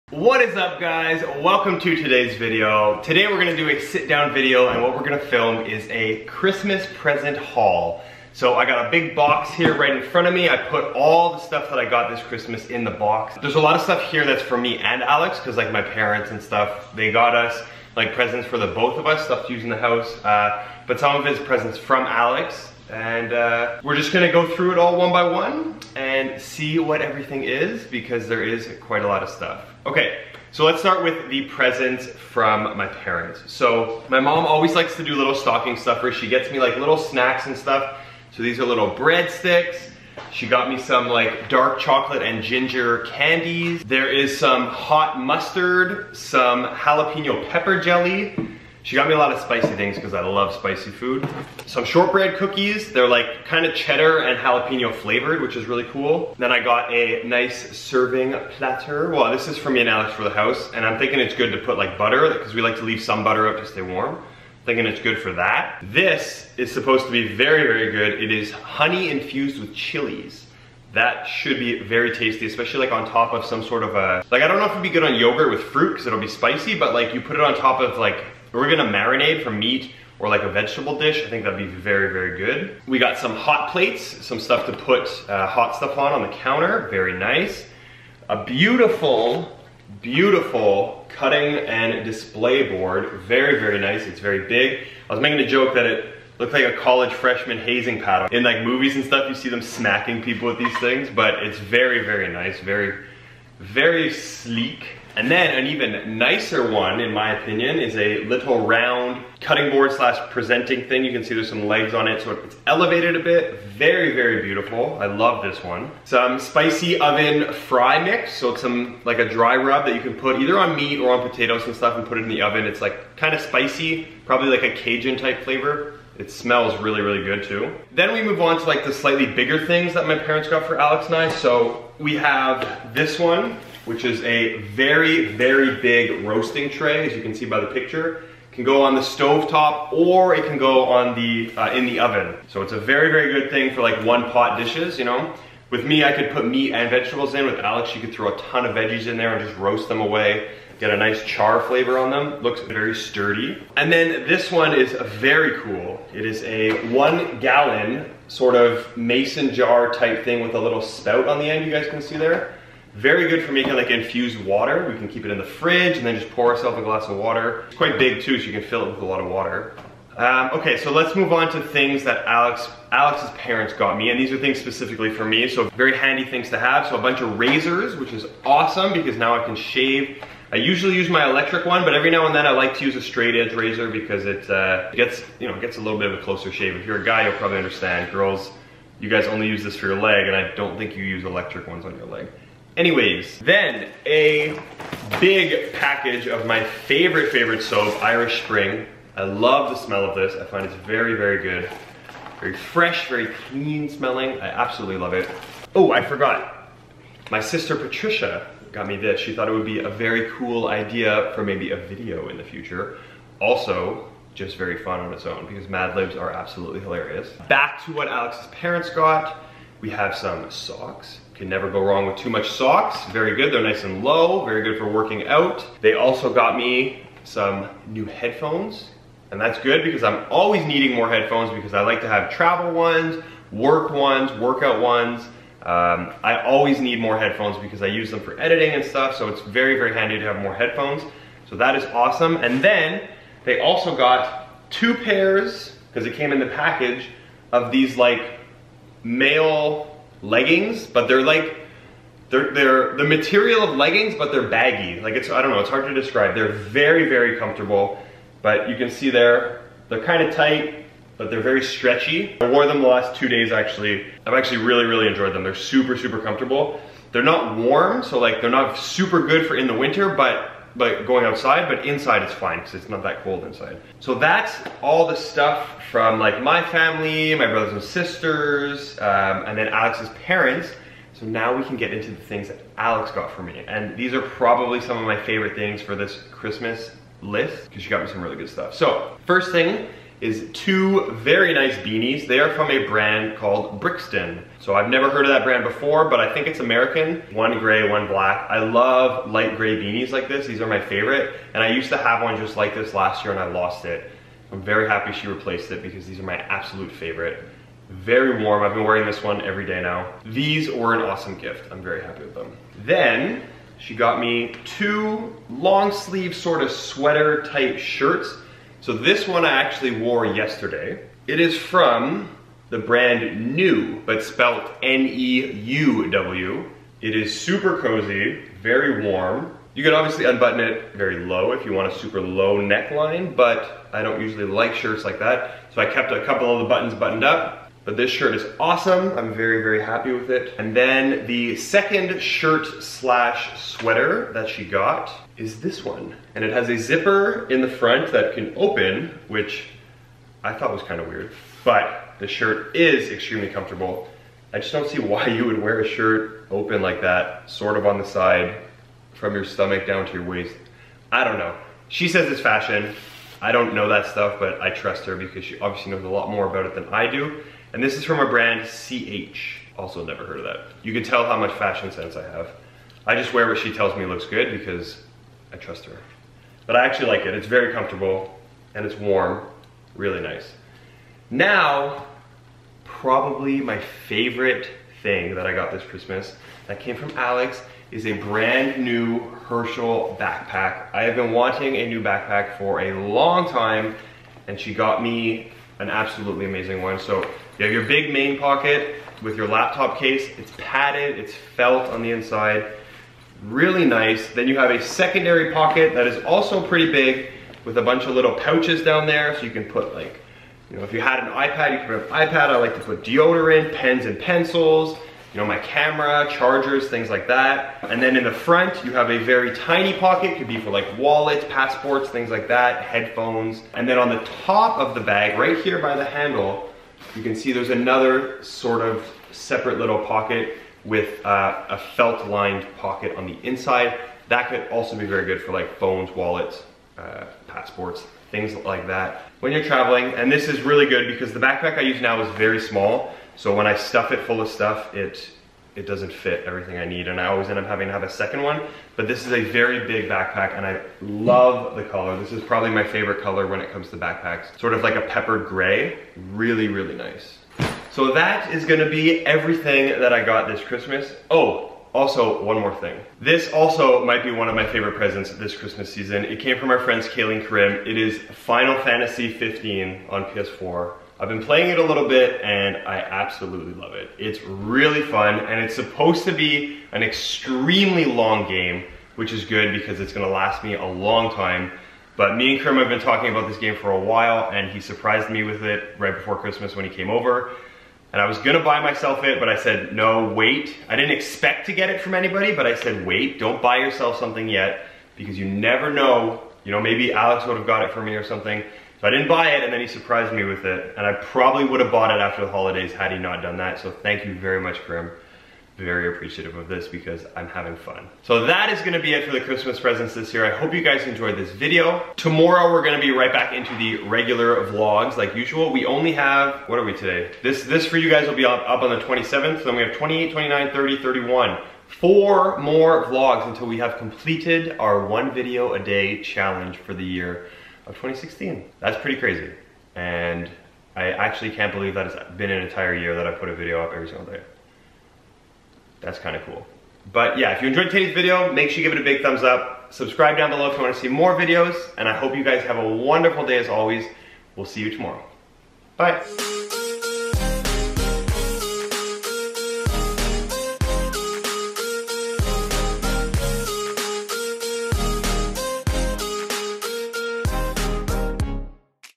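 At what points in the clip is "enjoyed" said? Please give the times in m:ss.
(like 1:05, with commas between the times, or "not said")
4:25, 8:31, 8:57.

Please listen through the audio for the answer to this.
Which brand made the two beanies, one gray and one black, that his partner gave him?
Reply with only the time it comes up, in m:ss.
4:53.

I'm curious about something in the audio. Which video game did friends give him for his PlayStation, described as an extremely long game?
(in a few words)
Final Fantasy 15.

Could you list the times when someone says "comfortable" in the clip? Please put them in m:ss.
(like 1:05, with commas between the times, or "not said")
4:17, 4:26, 5:53, 6:17.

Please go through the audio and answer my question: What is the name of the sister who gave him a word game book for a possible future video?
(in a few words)
Patricia.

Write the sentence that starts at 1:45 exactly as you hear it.
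And then an even nicer one, in my opinion, is a little round cutting board slash presenting thing.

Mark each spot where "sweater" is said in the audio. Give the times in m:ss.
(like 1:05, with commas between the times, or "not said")
5:16, 5:43.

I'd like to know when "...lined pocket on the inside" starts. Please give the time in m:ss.
7:12.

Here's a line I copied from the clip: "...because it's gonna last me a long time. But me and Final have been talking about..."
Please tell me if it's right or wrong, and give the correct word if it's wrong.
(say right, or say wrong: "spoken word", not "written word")
wrong: "Kerm", not "Final".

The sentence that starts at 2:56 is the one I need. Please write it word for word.
So a bunch of razors, which is awesome because now I can shave.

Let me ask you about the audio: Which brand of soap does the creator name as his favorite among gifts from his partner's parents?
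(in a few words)
Irish Spring.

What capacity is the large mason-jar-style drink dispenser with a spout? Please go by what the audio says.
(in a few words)
1 gallon.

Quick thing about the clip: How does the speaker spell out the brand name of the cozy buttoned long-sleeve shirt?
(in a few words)
N-E-U-W.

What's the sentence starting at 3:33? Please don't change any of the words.
Also, just very fun on its own because Mad Libs are absolutely hilarious.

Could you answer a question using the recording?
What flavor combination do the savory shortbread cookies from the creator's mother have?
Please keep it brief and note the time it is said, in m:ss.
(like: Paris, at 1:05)
cheddar and jalapeno, at 0:53.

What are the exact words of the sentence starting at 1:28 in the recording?
A beautiful, beautiful cutting and display board, very, very nice, it's very big.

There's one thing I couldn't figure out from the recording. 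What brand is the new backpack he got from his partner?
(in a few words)
Herschel.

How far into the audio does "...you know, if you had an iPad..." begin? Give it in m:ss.
6:50.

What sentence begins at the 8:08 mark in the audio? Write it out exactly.
And I was gonna buy myself it, but I said, no, wait.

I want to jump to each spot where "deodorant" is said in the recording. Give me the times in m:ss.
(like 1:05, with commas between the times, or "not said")
6:53.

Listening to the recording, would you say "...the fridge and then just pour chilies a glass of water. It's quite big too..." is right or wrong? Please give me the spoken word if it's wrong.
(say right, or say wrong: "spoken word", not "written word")
wrong: "ourselves", not "chilies".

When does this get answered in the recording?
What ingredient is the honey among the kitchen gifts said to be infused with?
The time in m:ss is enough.
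1:09.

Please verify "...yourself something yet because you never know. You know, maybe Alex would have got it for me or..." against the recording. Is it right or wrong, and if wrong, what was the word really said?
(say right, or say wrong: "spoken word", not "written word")
right.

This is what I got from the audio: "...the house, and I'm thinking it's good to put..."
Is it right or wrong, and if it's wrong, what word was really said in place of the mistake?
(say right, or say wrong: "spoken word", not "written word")
right.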